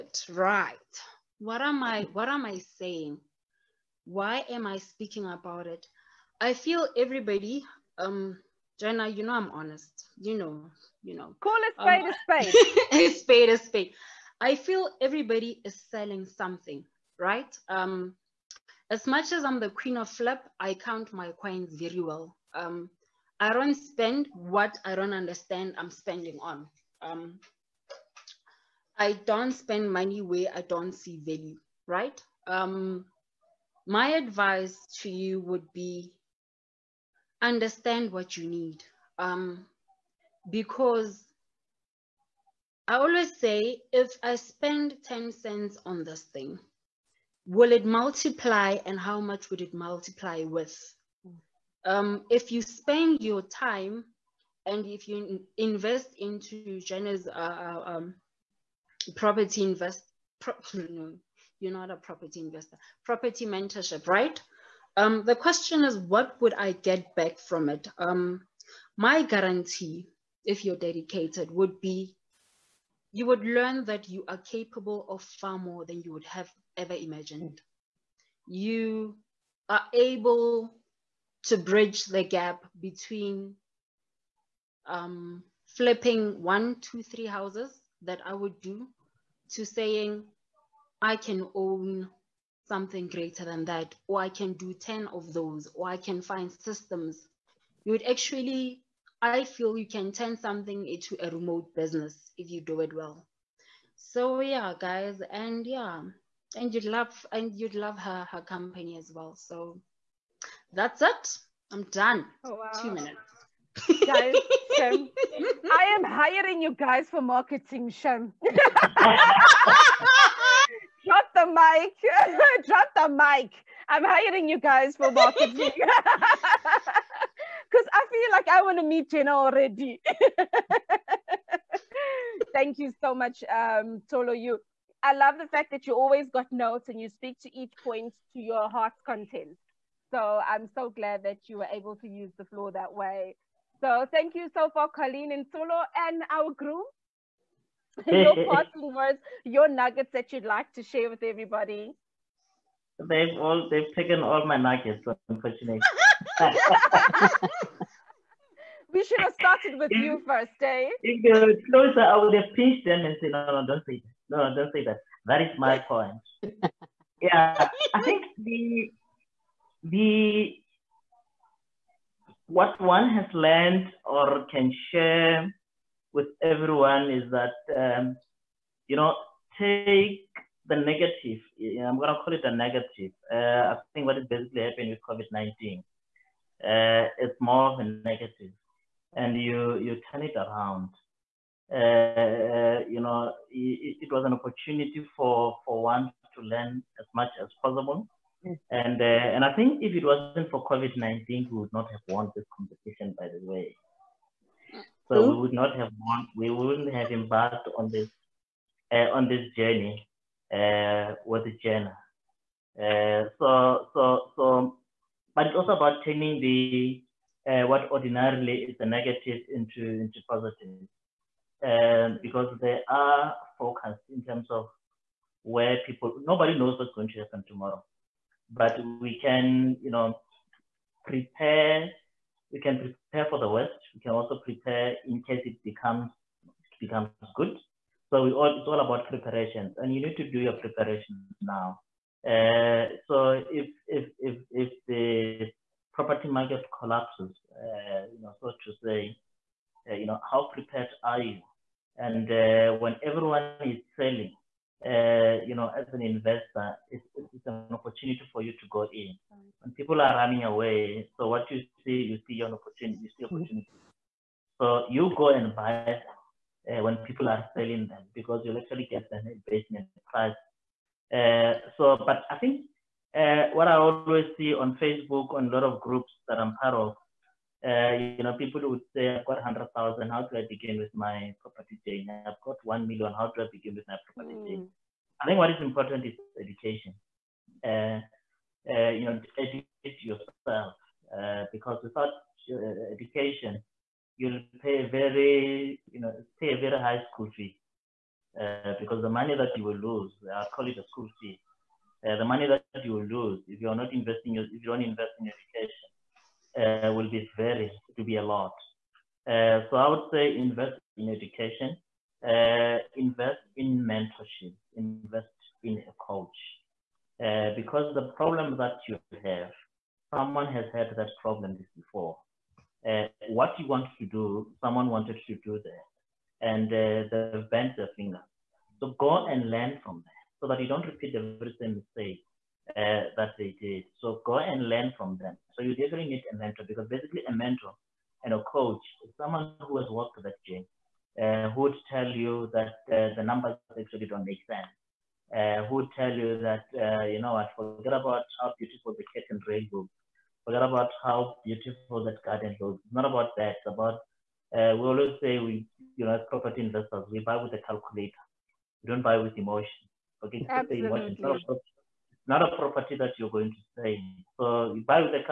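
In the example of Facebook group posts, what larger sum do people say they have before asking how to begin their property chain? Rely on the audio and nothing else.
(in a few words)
1 million.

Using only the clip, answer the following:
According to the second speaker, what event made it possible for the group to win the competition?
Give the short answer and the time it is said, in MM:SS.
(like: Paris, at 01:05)
COVID-19, at 03:05.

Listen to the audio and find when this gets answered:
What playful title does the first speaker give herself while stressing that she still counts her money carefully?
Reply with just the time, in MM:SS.
00:19.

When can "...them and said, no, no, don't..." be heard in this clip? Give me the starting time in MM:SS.
02:42.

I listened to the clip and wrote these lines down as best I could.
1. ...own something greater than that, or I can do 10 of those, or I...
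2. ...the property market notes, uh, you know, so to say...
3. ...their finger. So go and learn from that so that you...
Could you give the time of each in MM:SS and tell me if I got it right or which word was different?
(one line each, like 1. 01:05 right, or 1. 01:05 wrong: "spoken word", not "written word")
1. 01:31 right
2. 04:04 wrong: "collapses", not "notes"
3. 05:27 right.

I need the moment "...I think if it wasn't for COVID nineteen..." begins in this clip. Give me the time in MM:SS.
03:19.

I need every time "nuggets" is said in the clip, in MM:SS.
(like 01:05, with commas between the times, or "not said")
02:29, 02:34.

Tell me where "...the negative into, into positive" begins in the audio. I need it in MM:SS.
03:38.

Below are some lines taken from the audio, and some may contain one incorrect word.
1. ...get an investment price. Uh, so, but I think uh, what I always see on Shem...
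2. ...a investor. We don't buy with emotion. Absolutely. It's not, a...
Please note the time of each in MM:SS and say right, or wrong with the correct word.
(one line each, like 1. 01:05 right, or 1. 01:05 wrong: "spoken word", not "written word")
1. 04:28 wrong: "Facebook", not "Shem"
2. 05:57 wrong: "calculator", not "investor".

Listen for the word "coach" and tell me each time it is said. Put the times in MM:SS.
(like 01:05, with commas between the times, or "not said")
05:15, 05:38.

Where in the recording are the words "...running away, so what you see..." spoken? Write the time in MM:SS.
04:20.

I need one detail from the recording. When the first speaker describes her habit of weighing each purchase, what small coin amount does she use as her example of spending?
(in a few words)
10 cents.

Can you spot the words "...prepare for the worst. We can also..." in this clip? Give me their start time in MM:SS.
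03:53.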